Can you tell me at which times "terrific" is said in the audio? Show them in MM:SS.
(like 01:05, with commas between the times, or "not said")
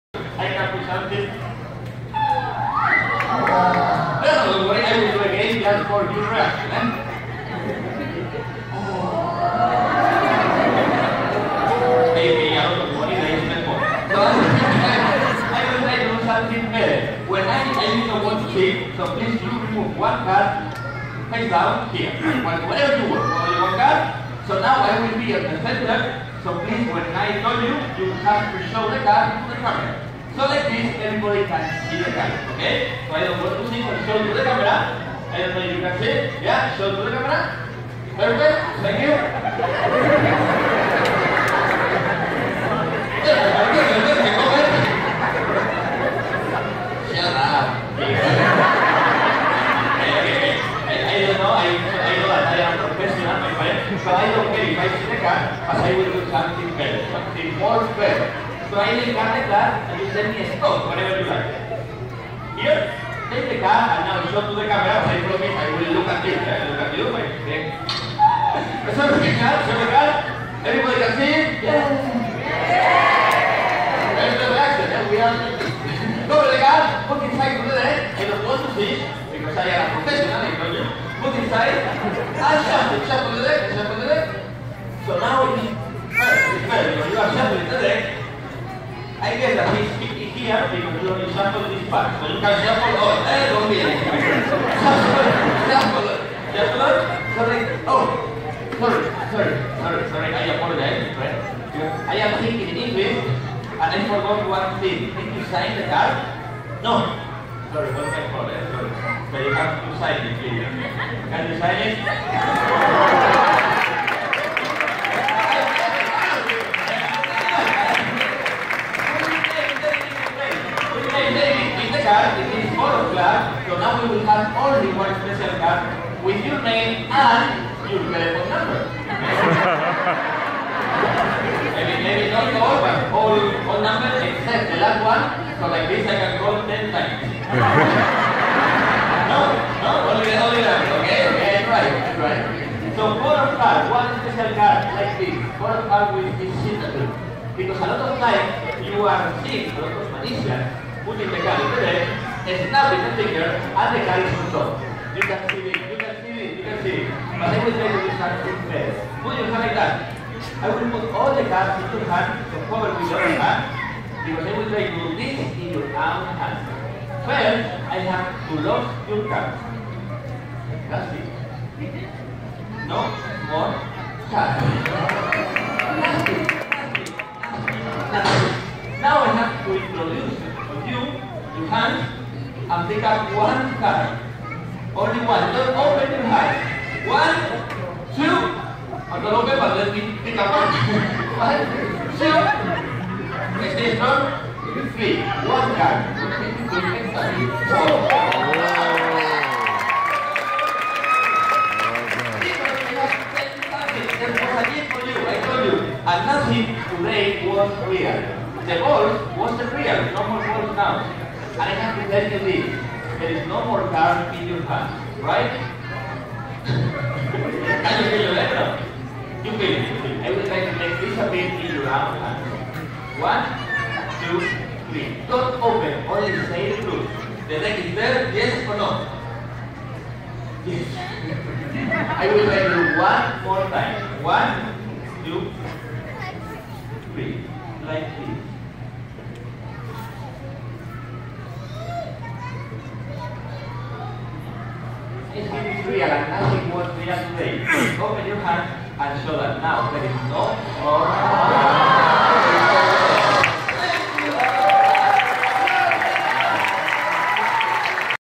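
not said.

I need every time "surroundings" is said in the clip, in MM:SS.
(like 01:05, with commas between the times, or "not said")
not said.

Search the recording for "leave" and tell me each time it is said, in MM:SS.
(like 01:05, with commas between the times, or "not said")
03:32.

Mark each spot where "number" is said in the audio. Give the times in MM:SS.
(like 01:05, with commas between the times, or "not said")
02:08, 02:13, 02:20.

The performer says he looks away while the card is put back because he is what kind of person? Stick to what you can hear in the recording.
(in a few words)
a professional.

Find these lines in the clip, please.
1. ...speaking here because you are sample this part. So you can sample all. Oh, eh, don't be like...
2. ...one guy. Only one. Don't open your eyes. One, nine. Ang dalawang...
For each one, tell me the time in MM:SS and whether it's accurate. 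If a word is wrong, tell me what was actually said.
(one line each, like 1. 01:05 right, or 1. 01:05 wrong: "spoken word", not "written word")
1. 01:29 right
2. 03:03 wrong: "two", not "nine".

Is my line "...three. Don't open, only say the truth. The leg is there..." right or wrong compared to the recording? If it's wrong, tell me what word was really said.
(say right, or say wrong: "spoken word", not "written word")
right.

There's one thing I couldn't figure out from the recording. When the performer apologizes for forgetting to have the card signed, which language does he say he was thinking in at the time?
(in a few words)
English.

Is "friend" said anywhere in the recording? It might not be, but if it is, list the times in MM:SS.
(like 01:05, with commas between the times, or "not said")
01:07, 01:41.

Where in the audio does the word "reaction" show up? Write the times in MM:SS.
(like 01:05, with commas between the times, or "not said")
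01:14.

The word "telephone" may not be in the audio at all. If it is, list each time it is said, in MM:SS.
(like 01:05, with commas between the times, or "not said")
02:08.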